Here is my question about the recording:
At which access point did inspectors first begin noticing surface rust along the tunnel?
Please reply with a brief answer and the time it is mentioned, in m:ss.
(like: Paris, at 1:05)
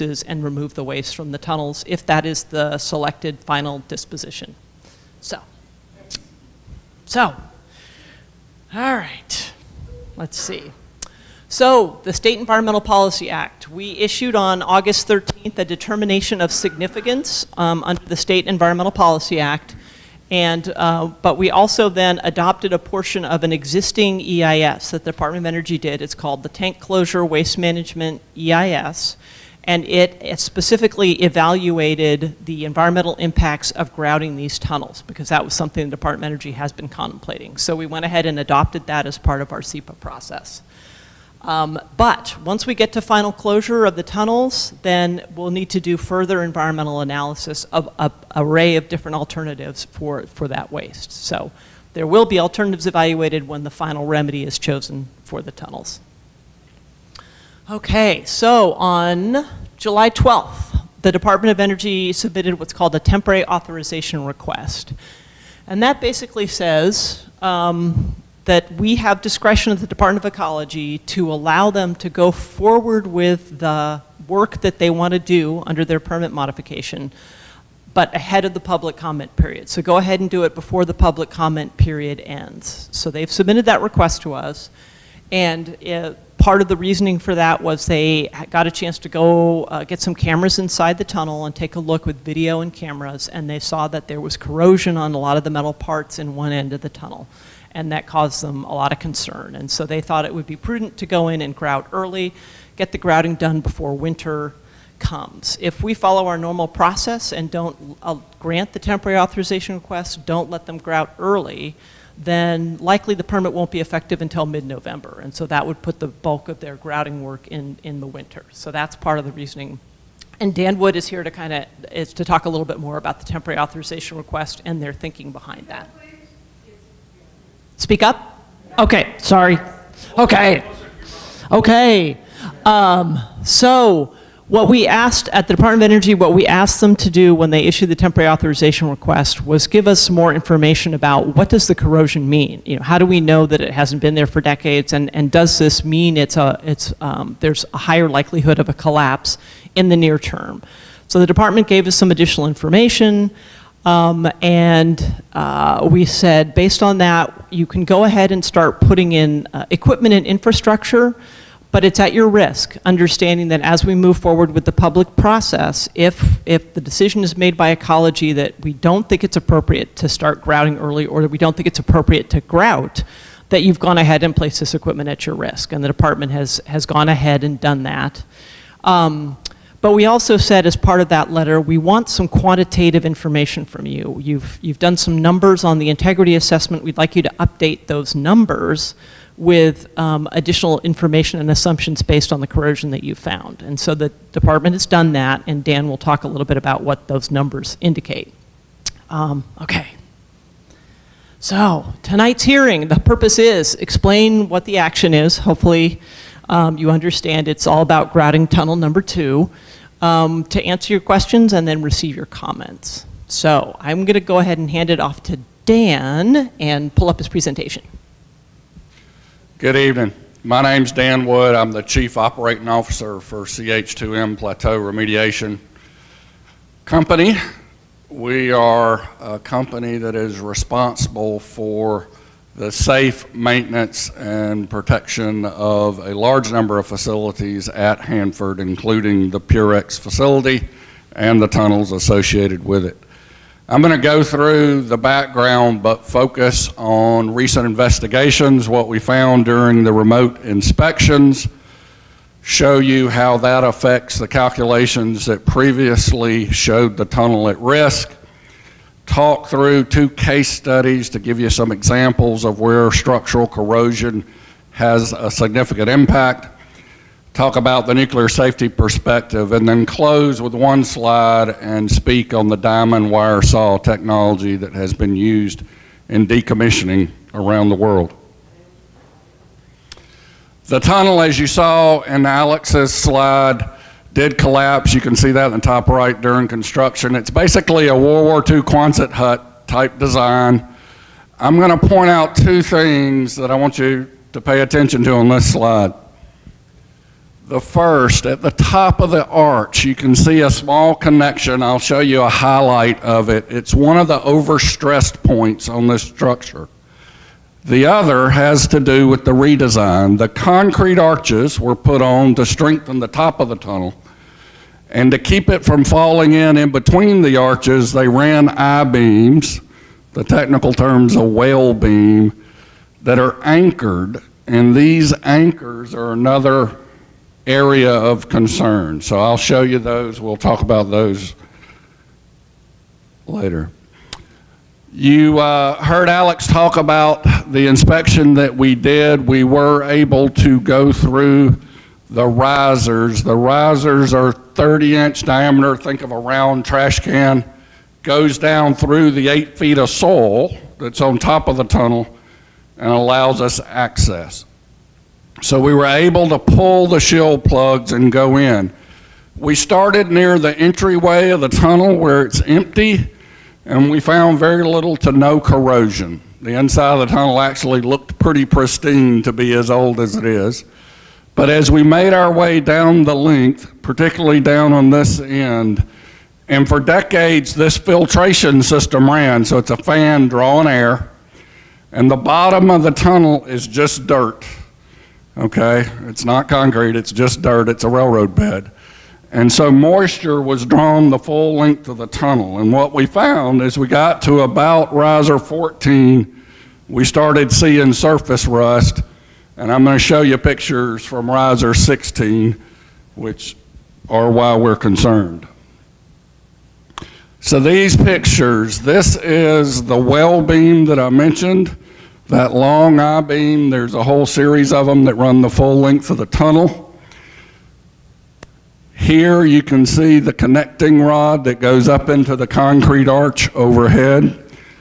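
riser 14, at 6:34.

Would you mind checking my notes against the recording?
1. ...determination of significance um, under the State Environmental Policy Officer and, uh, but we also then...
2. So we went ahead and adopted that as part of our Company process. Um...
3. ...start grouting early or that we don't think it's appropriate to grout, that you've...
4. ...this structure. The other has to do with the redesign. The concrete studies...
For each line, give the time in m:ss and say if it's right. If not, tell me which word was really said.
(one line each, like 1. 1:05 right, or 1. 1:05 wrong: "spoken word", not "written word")
1. 0:15 wrong: "Act", not "Officer"
2. 0:37 wrong: "SEPA", not "Company"
3. 2:50 right
4. 5:05 wrong: "arches", not "studies".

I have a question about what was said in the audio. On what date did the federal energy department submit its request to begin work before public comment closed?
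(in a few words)
July 12th.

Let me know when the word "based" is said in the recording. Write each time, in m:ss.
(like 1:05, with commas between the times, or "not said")
2:36, 3:12.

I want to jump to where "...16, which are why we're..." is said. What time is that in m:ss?
6:41.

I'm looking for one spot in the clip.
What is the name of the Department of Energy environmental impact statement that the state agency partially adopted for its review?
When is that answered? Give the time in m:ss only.
0:26.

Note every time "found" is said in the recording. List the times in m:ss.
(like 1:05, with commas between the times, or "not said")
3:13, 4:08, 6:04, 6:33.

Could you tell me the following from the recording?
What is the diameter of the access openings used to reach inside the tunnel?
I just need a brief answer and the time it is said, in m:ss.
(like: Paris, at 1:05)
30 inch, at 5:44.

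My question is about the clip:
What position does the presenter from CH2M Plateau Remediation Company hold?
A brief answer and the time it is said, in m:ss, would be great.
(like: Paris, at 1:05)
Chief Operating Officer, at 3:41.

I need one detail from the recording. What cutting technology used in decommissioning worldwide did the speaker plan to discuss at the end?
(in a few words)
diamond wire saw.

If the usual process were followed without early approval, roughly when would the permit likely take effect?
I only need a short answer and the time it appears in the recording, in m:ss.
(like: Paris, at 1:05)
mid-November, at 1:54.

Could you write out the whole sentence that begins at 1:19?
So go ahead and do it before the public comment period ends.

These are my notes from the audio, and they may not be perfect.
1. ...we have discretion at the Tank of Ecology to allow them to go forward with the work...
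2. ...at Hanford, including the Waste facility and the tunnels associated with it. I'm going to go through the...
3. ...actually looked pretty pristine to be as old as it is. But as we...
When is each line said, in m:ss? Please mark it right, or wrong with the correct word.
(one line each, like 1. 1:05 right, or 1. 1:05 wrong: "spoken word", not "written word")
1. 1:08 wrong: "Department", not "Tank"
2. 3:57 wrong: "Purex", not "Waste"
3. 6:07 right.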